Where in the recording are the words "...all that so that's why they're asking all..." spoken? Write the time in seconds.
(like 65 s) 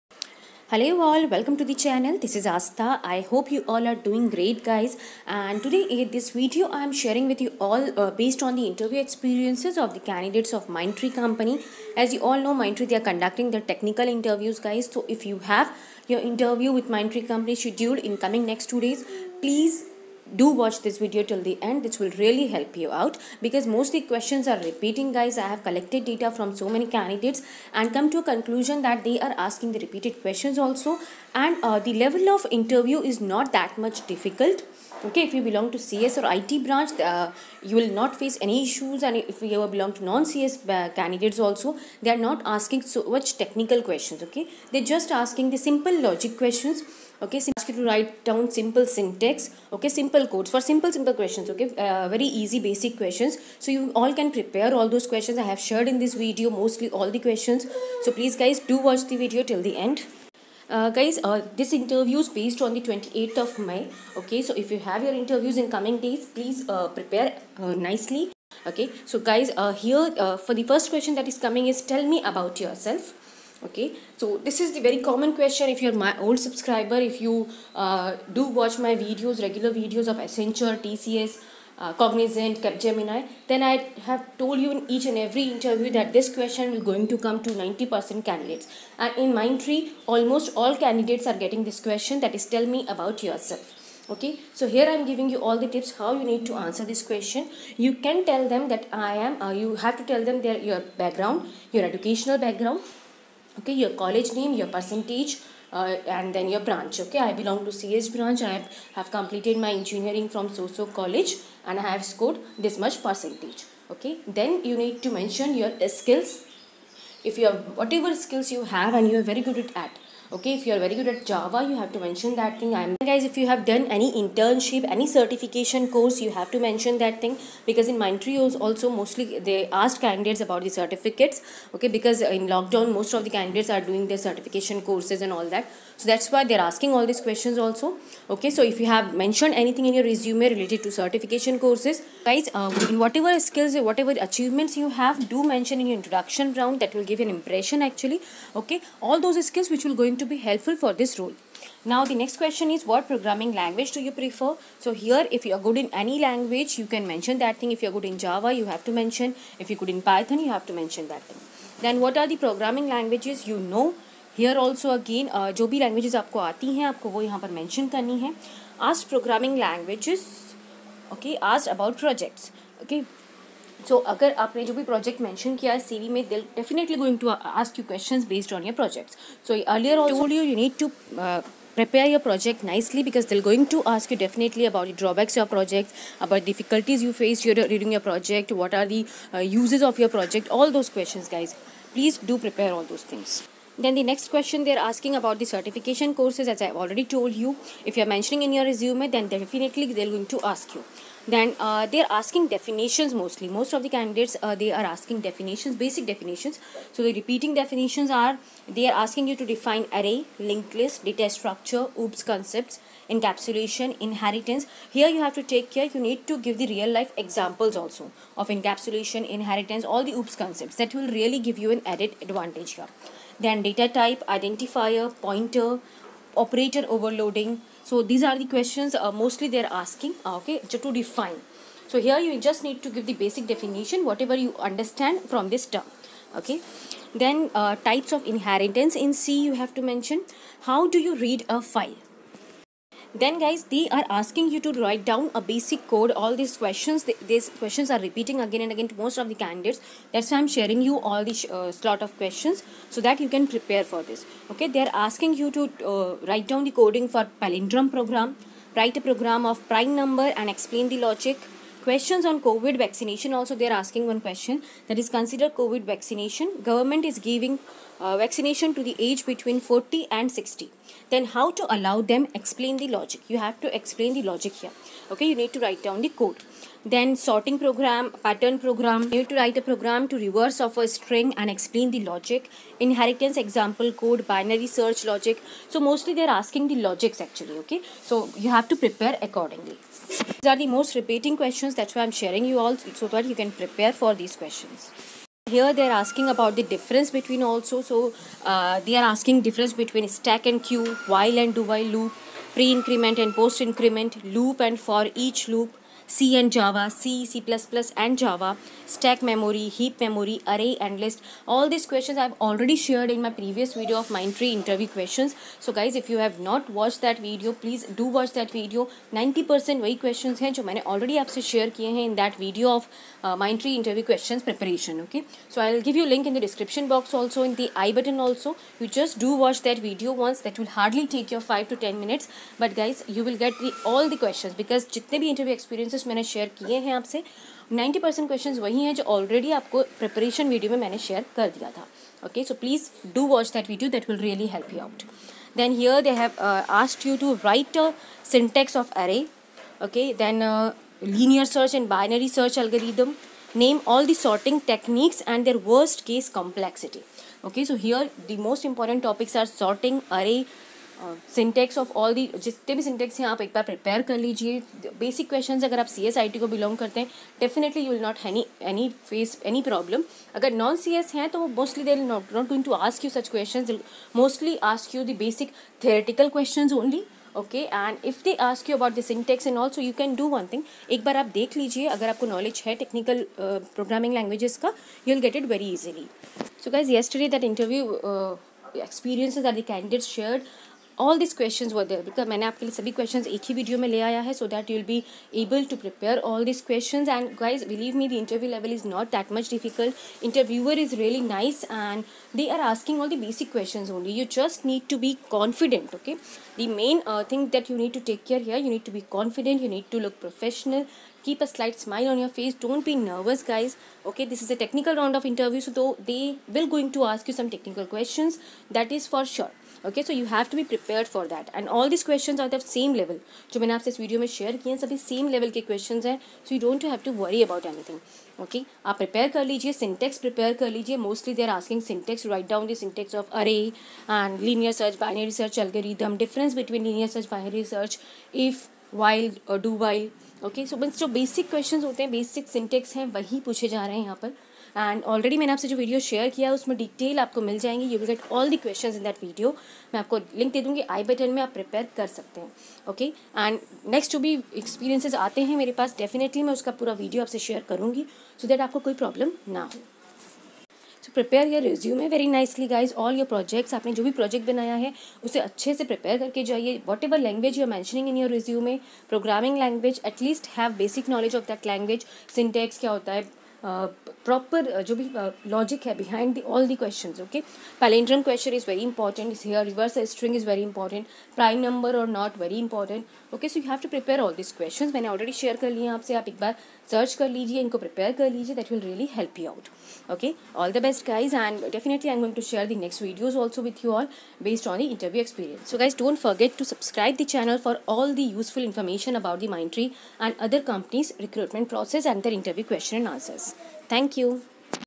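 135 s.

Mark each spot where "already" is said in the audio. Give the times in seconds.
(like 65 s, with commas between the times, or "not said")
196 s, 312 s, 320 s.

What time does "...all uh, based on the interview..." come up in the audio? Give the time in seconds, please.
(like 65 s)
7 s.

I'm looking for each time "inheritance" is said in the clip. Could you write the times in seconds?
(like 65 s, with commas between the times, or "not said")
213 s, 219 s, 238 s, 282 s.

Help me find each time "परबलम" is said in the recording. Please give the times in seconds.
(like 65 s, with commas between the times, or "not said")
369 s, 459 s.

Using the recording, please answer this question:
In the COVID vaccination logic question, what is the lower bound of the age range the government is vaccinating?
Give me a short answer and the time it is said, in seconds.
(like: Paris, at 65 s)
40, at 269 s.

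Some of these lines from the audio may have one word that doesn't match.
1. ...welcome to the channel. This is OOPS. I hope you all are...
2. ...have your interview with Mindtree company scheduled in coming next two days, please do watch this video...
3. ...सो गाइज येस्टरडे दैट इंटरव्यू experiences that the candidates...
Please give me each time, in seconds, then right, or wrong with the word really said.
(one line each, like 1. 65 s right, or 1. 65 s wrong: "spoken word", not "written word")
1. 1 s wrong: "Astha", not "OOPS"
2. 15 s right
3. 386 s right.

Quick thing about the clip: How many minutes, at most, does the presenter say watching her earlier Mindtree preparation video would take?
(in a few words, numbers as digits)
ten minutes.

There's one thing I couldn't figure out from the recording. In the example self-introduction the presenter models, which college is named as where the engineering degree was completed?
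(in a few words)
soso college.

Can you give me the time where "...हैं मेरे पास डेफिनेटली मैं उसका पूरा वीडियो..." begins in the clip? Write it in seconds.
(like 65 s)
455 s.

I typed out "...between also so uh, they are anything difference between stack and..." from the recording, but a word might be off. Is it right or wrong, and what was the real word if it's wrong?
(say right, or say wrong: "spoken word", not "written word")
wrong: "asking", not "anything".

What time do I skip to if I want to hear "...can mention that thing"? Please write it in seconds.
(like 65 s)
156 s.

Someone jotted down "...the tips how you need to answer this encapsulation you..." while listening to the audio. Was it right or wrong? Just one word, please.
wrong.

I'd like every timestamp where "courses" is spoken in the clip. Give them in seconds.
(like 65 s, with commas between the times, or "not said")
125 s, 134 s, 141 s, 196 s.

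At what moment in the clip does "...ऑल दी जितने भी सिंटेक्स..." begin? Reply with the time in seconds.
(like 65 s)
361 s.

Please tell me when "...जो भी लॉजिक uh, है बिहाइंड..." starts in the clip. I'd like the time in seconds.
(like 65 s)
474 s.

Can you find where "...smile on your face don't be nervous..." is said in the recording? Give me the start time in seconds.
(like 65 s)
411 s.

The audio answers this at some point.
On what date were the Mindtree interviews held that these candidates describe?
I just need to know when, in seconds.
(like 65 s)
62 s.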